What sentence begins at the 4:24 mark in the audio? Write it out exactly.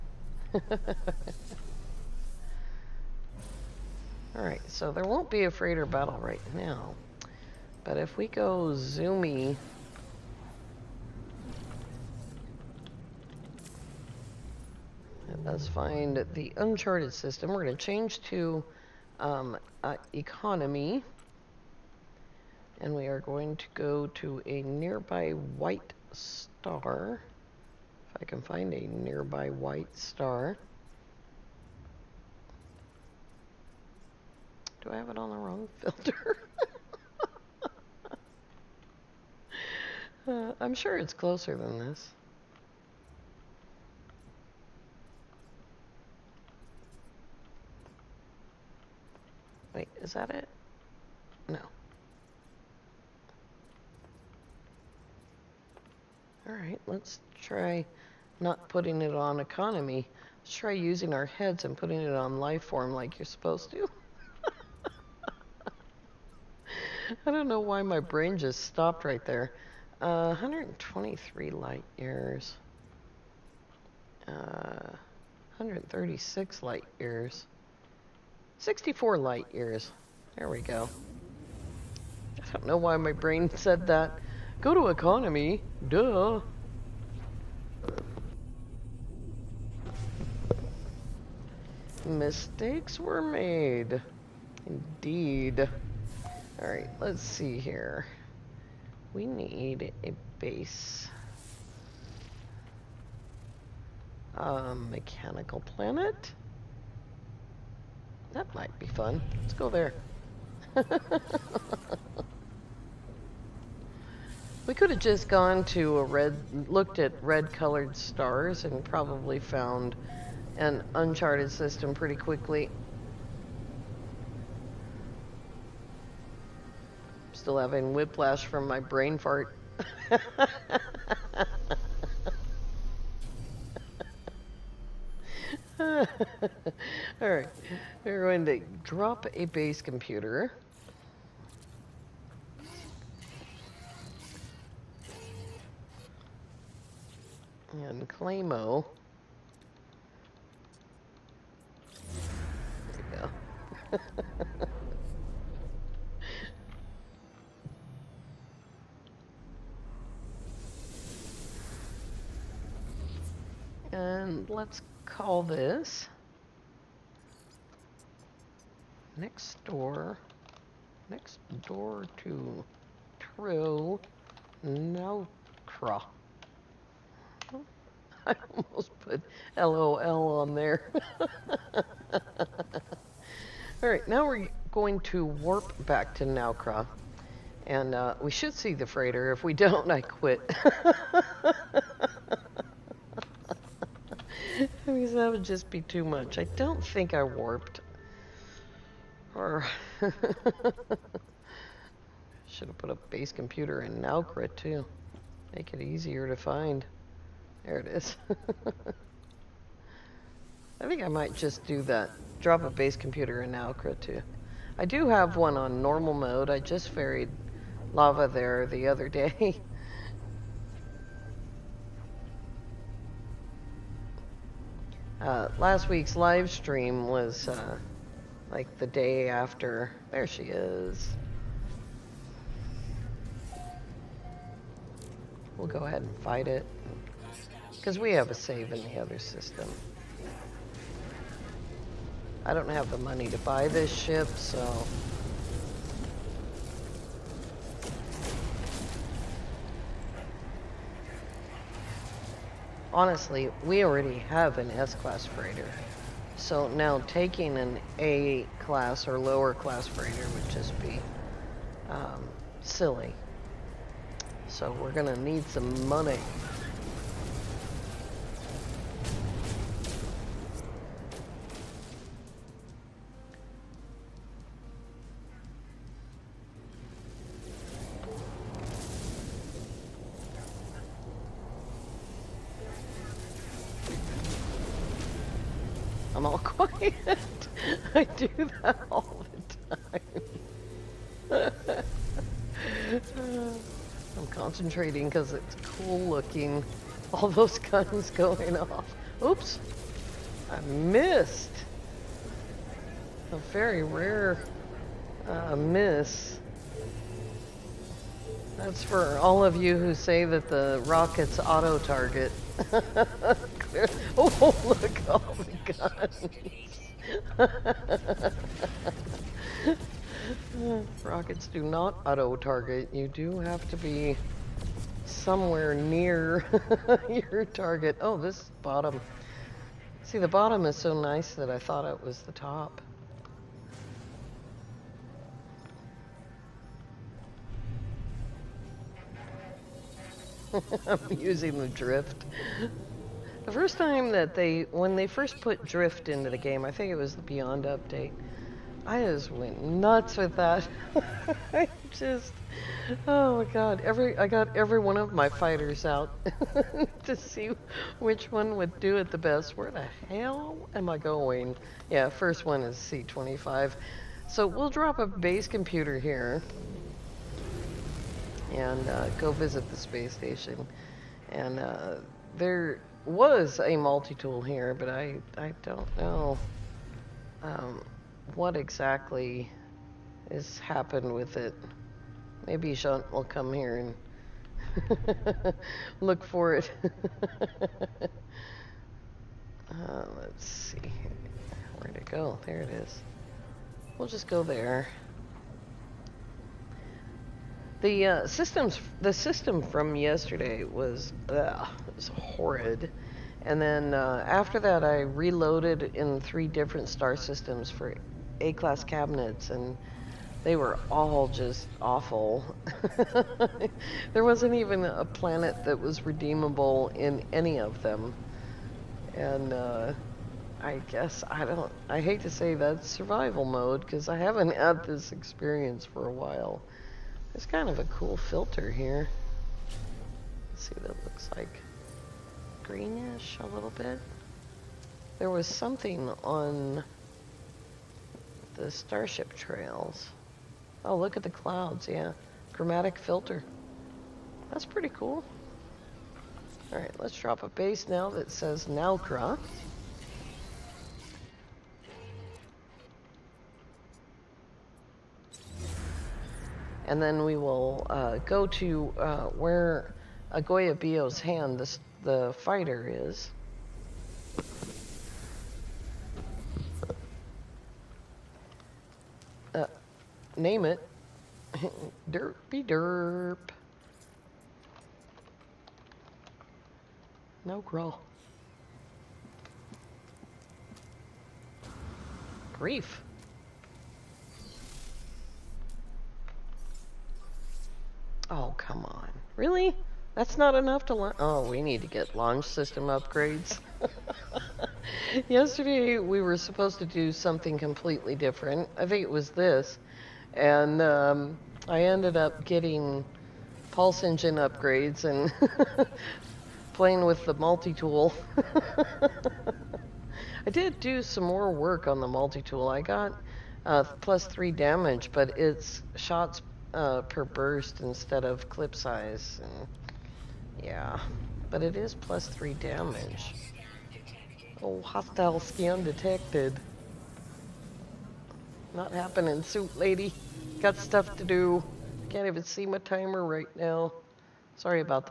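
So we're going to need some money.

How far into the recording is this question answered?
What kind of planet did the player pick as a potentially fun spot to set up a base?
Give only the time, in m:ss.
1:44.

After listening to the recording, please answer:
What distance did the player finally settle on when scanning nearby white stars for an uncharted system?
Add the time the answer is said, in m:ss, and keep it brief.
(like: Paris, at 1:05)
64 light years, at 1:18.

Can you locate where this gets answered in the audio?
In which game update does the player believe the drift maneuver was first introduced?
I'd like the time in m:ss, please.
5:47.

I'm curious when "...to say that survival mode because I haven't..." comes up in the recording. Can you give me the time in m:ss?
7:02.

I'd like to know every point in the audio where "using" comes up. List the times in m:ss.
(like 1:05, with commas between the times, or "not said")
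1:00, 5:41.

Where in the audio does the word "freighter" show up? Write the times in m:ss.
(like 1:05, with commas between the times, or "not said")
0:05, 3:08, 4:15, 4:19.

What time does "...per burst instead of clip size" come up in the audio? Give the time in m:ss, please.
8:37.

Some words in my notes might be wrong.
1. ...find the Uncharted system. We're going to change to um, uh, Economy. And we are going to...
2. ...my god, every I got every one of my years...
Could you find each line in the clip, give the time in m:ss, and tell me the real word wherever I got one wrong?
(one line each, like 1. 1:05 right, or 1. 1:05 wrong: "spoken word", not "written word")
1. 0:15 right
2. 5:53 wrong: "fighters", not "years".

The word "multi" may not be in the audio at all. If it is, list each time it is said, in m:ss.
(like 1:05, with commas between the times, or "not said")
6:13, 8:27, 8:32.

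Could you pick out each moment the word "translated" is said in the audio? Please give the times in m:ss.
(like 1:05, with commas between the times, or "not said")
not said.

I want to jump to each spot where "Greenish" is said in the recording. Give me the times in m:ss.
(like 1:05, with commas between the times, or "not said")
7:12.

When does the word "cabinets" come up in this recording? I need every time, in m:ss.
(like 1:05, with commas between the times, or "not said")
6:48.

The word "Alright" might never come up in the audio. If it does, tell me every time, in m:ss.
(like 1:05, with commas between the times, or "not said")
0:04, 0:56, 1:36, 7:26.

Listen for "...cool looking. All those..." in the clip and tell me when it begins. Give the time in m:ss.
4:55.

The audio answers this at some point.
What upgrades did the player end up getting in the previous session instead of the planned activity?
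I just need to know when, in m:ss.
8:23.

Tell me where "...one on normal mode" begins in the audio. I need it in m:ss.
3:35.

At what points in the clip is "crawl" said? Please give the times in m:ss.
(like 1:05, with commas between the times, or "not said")
7:57.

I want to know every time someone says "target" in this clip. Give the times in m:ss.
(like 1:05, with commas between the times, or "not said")
5:11, 5:22, 5:27.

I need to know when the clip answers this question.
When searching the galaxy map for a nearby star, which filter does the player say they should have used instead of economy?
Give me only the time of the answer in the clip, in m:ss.
1:02.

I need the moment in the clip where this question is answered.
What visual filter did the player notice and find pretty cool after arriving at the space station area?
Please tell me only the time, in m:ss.
7:22.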